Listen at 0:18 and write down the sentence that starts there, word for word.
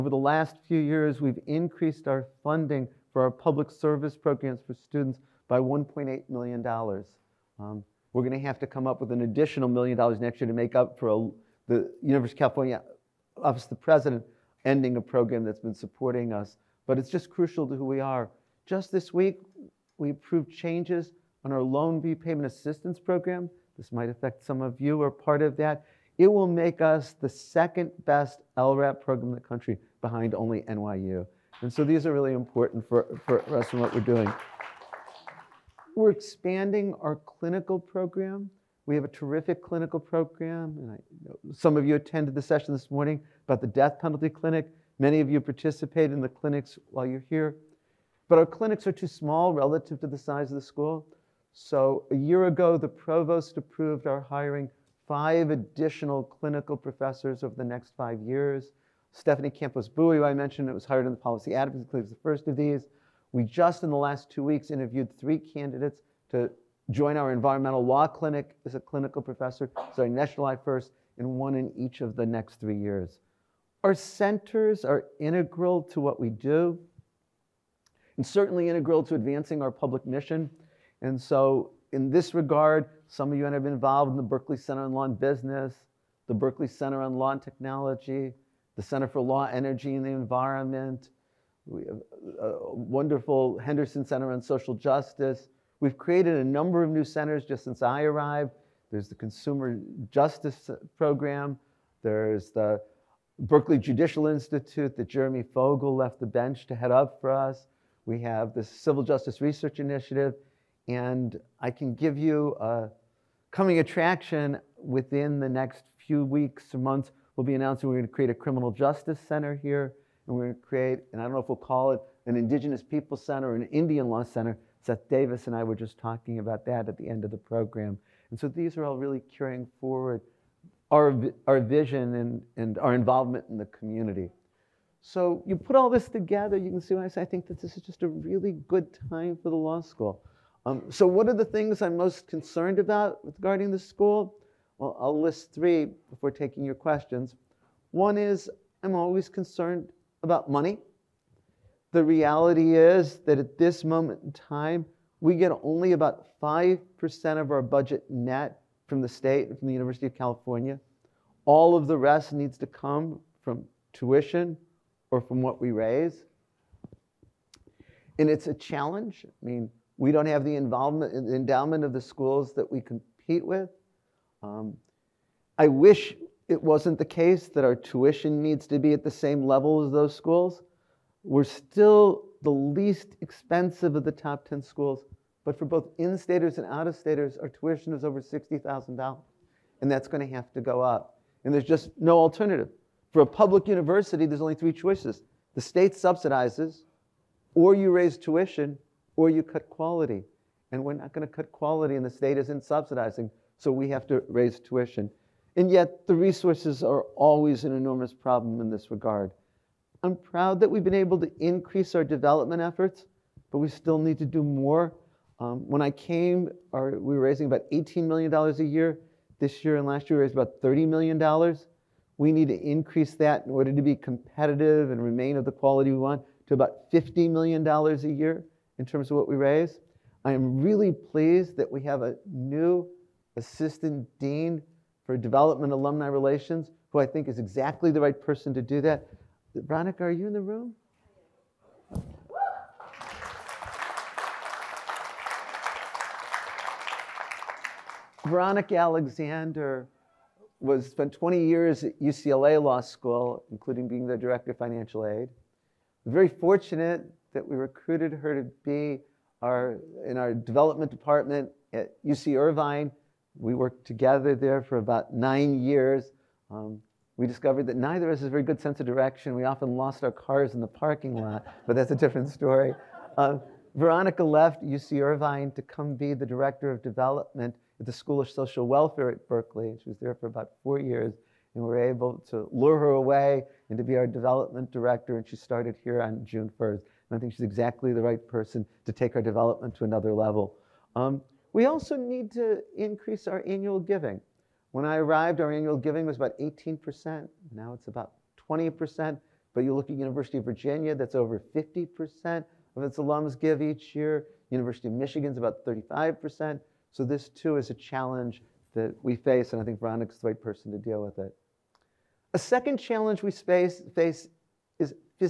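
Just this week, we approved changes on our loan repayment assistance program.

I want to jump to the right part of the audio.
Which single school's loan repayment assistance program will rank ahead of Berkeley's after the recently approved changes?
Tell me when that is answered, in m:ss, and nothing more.
0:30.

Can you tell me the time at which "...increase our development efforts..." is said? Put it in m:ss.
3:31.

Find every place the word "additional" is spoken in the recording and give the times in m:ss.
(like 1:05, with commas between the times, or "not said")
0:09, 0:55.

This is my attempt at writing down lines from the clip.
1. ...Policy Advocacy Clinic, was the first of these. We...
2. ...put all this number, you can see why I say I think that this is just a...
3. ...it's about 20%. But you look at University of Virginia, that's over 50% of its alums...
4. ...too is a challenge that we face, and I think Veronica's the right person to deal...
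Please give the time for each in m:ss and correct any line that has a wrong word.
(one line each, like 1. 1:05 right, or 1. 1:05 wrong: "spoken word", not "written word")
1. 1:01 right
2. 2:15 wrong: "together", not "number"
3. 4:57 right
4. 5:07 right.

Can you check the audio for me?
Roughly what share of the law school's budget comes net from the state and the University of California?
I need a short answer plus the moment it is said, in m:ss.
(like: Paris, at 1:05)
5%, at 2:36.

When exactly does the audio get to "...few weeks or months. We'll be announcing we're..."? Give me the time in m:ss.
1:55.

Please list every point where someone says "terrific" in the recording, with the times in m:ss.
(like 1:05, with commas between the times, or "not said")
0:39.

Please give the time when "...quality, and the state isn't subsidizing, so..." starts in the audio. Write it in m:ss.
3:21.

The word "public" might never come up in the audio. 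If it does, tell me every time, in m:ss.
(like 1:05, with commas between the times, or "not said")
0:03, 1:19, 3:13.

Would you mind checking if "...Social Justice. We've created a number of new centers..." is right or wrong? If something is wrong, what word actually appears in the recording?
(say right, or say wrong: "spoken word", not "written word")
right.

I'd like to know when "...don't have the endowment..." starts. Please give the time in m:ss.
2:50.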